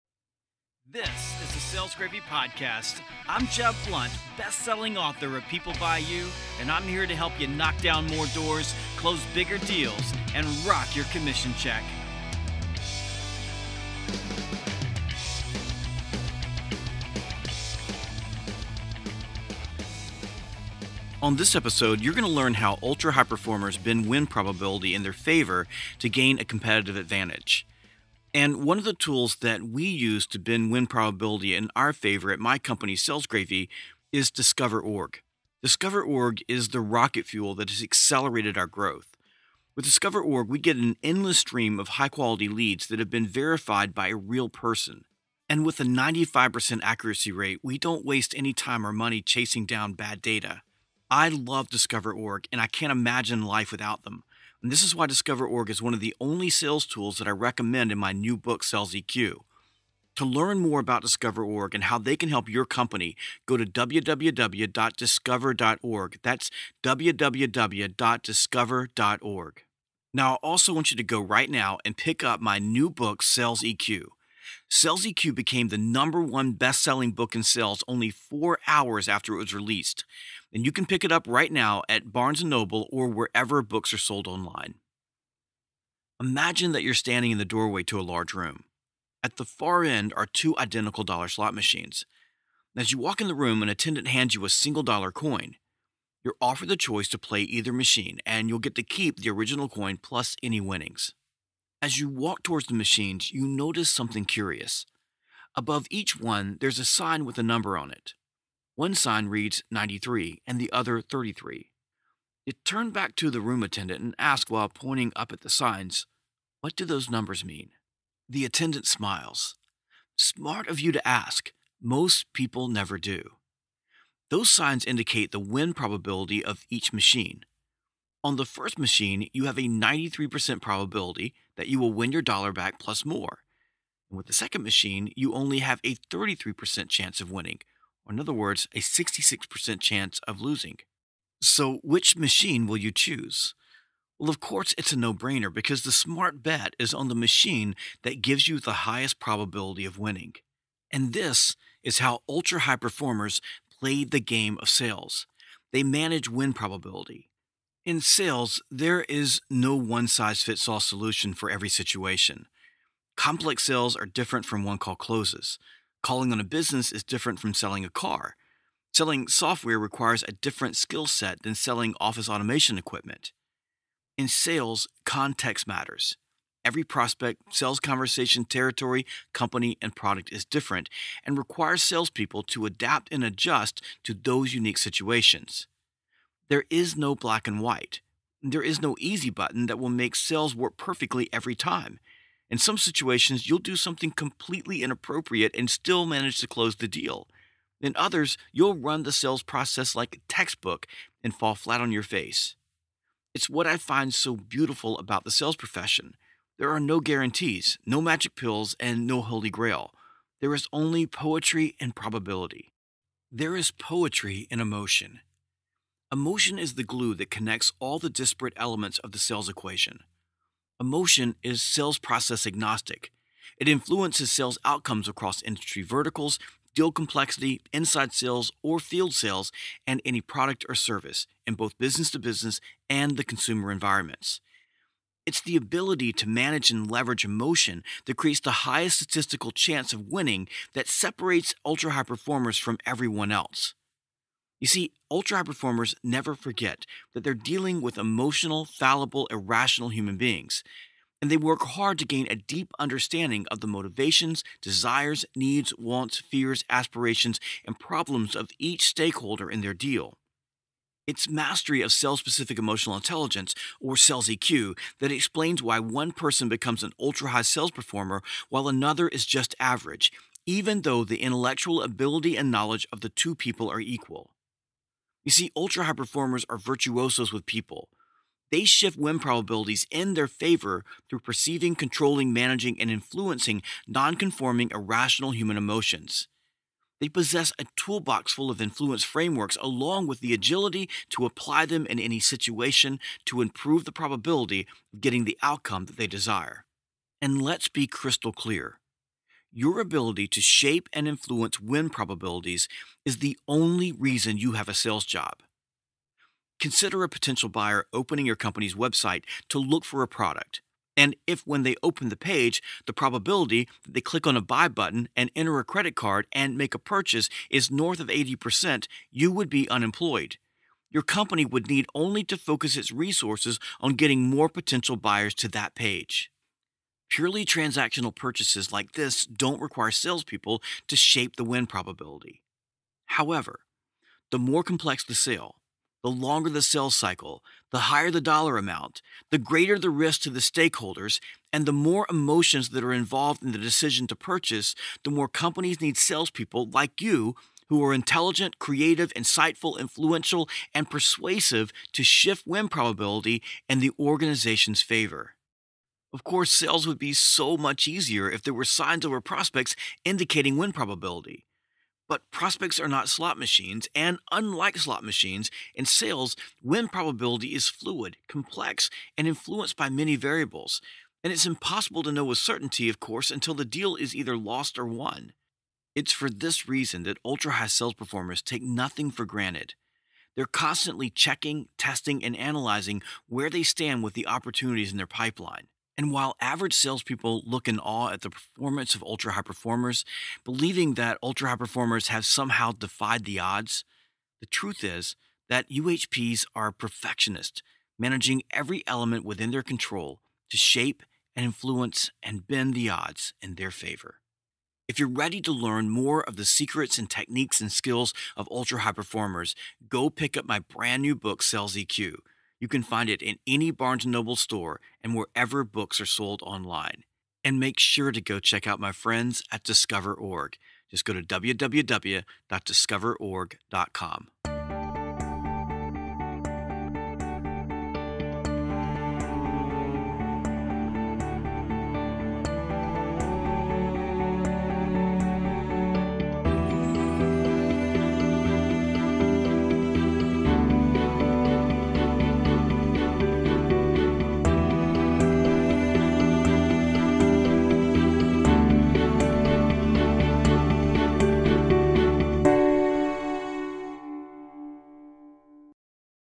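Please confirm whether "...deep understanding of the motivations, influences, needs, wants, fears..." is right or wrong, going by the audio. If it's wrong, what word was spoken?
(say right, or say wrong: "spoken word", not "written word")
wrong: "desires", not "influences".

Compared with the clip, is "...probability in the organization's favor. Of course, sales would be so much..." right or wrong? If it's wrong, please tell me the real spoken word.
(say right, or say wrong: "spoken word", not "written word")
right.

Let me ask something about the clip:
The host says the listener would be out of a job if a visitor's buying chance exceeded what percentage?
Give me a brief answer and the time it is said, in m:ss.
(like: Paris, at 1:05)
80%, at 5:18.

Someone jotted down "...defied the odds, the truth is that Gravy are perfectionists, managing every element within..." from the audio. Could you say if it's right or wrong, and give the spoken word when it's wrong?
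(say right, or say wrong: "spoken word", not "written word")
wrong: "UHPs", not "Gravy".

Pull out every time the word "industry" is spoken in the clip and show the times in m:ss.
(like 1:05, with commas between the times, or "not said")
3:45.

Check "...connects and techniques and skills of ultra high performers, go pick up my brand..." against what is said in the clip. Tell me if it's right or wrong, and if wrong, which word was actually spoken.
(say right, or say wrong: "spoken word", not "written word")
wrong: "secrets", not "connects".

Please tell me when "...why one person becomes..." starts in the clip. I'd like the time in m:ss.
4:25.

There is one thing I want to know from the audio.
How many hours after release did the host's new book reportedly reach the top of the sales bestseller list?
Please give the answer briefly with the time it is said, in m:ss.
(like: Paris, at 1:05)
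4, at 1:18.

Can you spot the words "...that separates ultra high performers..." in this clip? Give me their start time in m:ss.
4:00.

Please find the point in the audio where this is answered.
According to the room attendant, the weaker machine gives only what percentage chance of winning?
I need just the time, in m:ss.
2:15.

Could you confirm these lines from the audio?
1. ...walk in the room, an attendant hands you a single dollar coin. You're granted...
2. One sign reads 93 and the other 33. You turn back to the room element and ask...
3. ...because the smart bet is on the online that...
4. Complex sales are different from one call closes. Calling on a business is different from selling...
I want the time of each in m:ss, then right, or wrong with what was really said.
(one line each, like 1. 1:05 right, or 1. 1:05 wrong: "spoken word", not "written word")
1. 1:32 wrong: "offered", not "granted"
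2. 1:48 wrong: "attendant", not "element"
3. 2:25 wrong: "machine", not "online"
4. 2:43 right.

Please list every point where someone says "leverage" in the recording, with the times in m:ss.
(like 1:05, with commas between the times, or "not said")
3:56.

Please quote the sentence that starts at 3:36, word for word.
Emotion is the glue that connects all the disparate elements of the sales equation.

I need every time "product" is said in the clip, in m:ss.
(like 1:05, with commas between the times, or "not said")
2:59, 3:50, 5:10.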